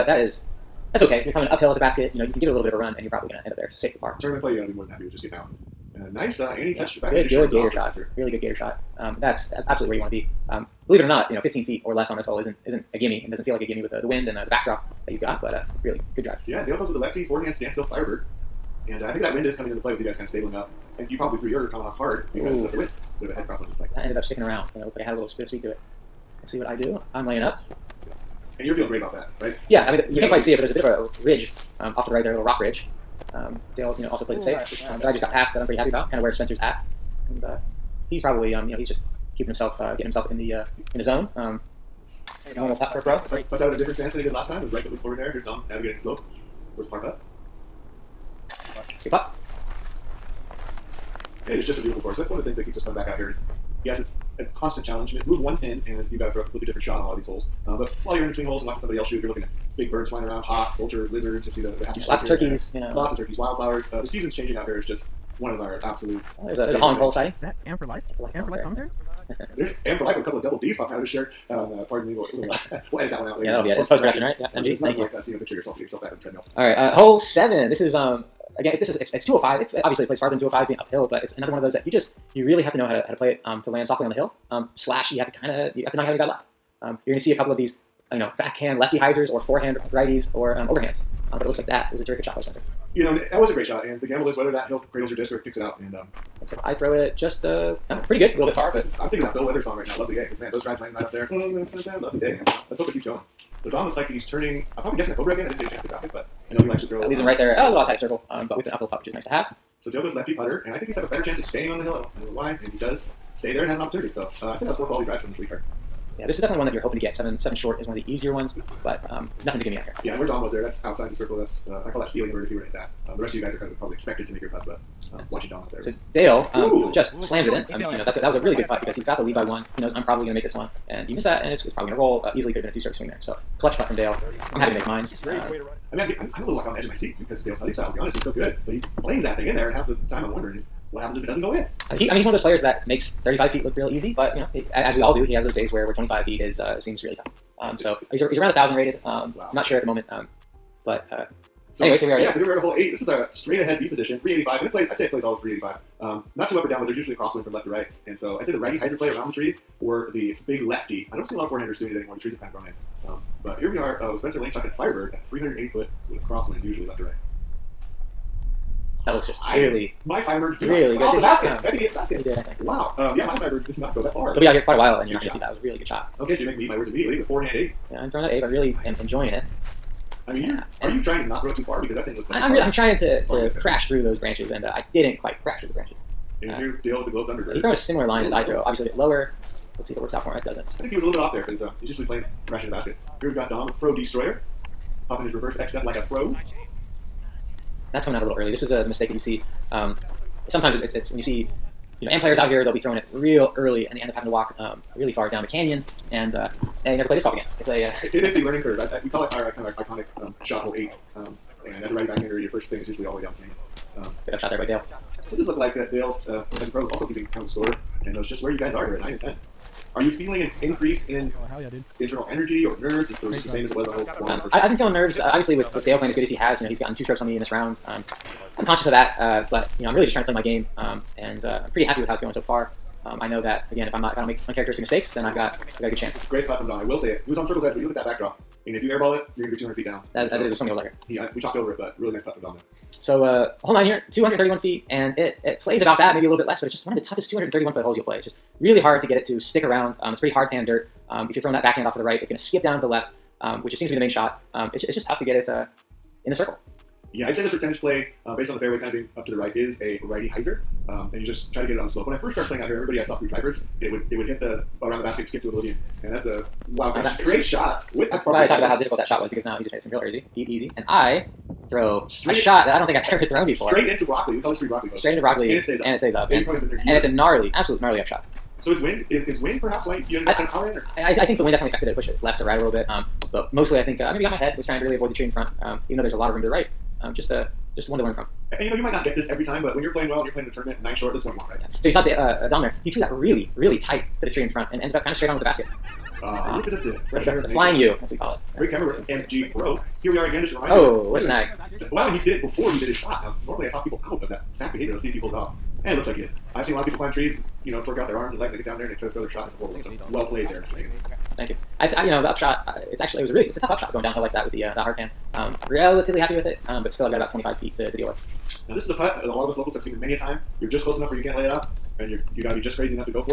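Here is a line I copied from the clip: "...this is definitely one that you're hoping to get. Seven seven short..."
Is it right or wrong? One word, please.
right.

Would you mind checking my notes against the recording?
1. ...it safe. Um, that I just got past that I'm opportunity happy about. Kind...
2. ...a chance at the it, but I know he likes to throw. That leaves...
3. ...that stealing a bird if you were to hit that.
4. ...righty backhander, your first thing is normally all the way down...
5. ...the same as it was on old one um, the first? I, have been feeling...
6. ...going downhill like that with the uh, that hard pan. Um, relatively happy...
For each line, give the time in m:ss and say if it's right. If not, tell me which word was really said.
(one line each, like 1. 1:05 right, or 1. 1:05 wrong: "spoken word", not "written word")
1. 0:34 wrong: "pretty", not "opportunity"
2. 1:45 right
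3. 2:02 right
4. 3:31 wrong: "usually", not "normally"
5. 3:43 right
6. 5:13 right.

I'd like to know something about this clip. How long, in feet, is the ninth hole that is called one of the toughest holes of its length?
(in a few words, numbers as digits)
231.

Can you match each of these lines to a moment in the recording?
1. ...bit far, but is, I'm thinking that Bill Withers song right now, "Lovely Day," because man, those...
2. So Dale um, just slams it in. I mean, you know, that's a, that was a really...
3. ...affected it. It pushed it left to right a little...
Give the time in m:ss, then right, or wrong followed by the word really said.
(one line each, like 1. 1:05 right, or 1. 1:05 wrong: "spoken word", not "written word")
1. 1:38 right
2. 2:05 right
3. 4:41 right.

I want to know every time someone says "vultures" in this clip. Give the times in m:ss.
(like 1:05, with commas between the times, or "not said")
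1:00.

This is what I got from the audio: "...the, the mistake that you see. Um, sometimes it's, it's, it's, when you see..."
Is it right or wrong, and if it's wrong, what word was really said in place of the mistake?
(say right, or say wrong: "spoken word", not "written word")
right.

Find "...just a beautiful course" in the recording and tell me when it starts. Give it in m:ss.
0:51.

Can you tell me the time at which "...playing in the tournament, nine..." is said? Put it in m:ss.
4:50.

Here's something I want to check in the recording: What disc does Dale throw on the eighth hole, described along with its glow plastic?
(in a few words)
Thunderbird.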